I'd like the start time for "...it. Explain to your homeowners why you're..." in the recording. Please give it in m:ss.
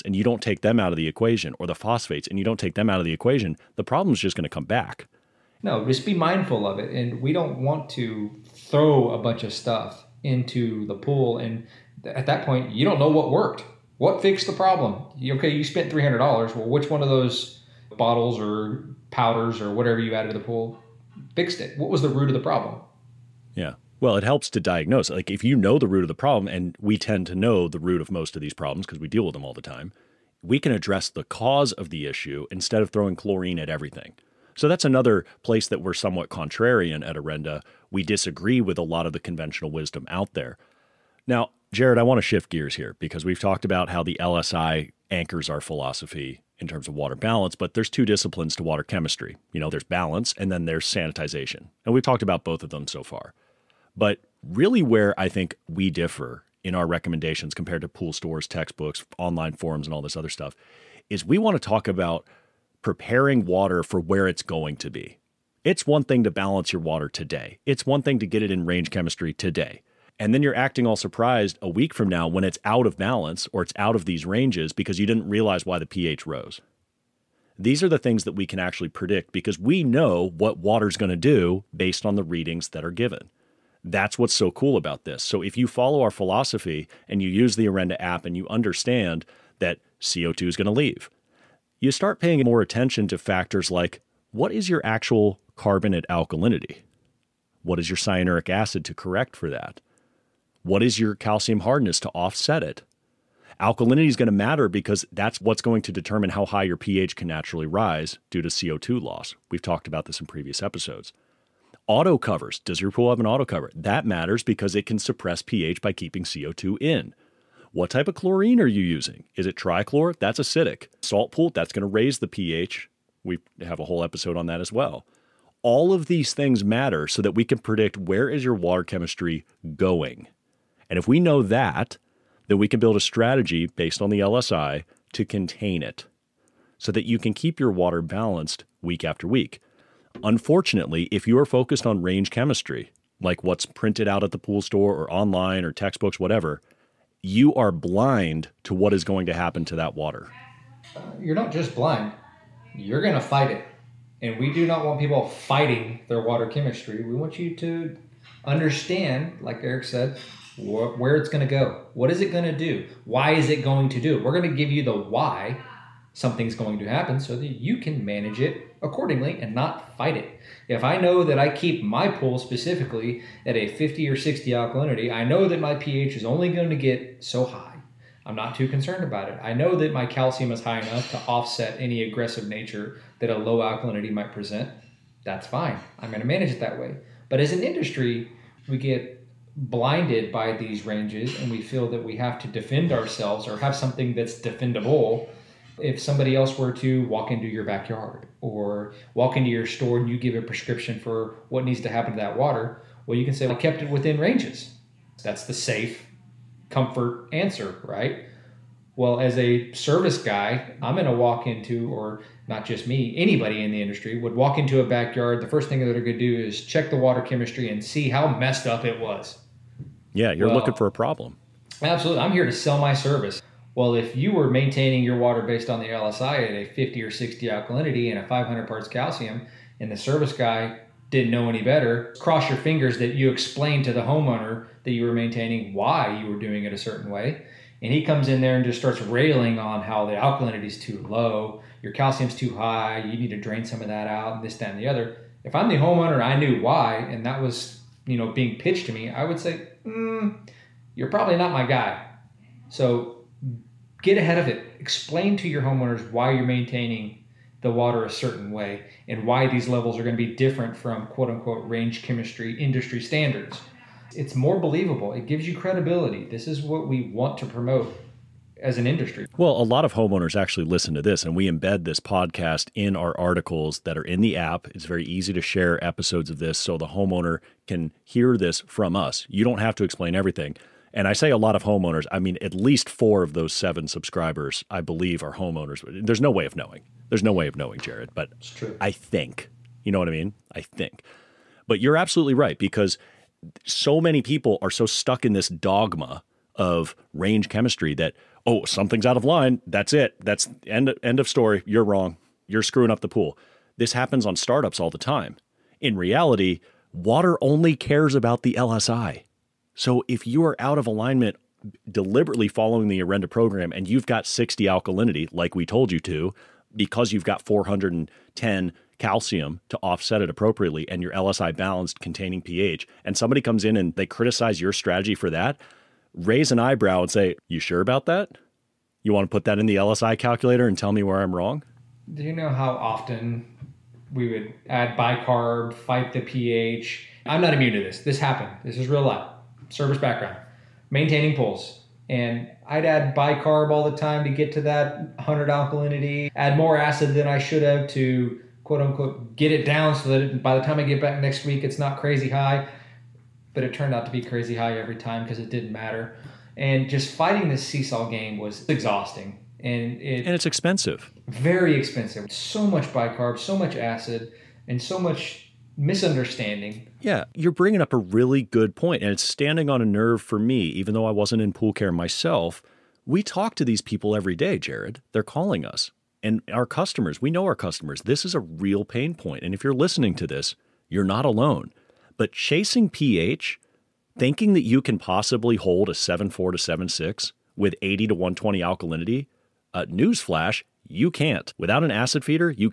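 4:14.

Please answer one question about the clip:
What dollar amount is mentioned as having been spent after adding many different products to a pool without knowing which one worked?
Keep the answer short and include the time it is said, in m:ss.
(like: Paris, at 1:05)
$300, at 0:15.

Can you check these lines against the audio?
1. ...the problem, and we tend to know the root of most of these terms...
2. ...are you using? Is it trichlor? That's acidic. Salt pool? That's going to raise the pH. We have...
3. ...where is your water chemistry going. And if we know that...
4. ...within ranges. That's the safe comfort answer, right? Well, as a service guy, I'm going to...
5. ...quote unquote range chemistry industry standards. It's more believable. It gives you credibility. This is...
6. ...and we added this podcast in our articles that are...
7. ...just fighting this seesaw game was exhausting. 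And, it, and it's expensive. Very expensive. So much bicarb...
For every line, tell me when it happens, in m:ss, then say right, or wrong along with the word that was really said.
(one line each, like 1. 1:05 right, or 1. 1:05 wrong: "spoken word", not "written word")
1. 0:26 wrong: "problems", not "terms"
2. 1:58 right
3. 2:07 right
4. 3:23 right
5. 4:21 right
6. 4:31 wrong: "embed", not "added"
7. 5:56 right.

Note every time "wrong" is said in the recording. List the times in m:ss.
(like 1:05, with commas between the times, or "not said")
5:01, 5:31.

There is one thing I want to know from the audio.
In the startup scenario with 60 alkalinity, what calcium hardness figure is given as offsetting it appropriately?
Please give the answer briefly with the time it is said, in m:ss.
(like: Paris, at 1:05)
410, at 5:17.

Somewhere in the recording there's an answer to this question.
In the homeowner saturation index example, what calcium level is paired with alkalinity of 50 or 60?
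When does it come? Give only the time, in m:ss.
3:48.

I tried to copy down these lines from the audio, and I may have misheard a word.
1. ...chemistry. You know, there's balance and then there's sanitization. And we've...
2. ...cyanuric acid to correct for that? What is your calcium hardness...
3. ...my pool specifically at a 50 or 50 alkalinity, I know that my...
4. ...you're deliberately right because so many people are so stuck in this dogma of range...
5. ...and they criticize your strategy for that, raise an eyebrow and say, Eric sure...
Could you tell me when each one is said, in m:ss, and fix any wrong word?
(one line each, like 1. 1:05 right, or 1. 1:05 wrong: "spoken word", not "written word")
1. 0:48 right
2. 1:37 right
3. 2:51 wrong: "60", not "50"
4. 4:51 wrong: "absolutely", not "deliberately"
5. 5:23 wrong: "You", not "Eric".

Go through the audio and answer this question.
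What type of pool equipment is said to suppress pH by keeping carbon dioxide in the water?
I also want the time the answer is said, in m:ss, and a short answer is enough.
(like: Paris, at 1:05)
Auto covers, at 1:51.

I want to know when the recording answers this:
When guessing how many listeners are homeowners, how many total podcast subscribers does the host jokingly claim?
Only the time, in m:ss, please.
4:43.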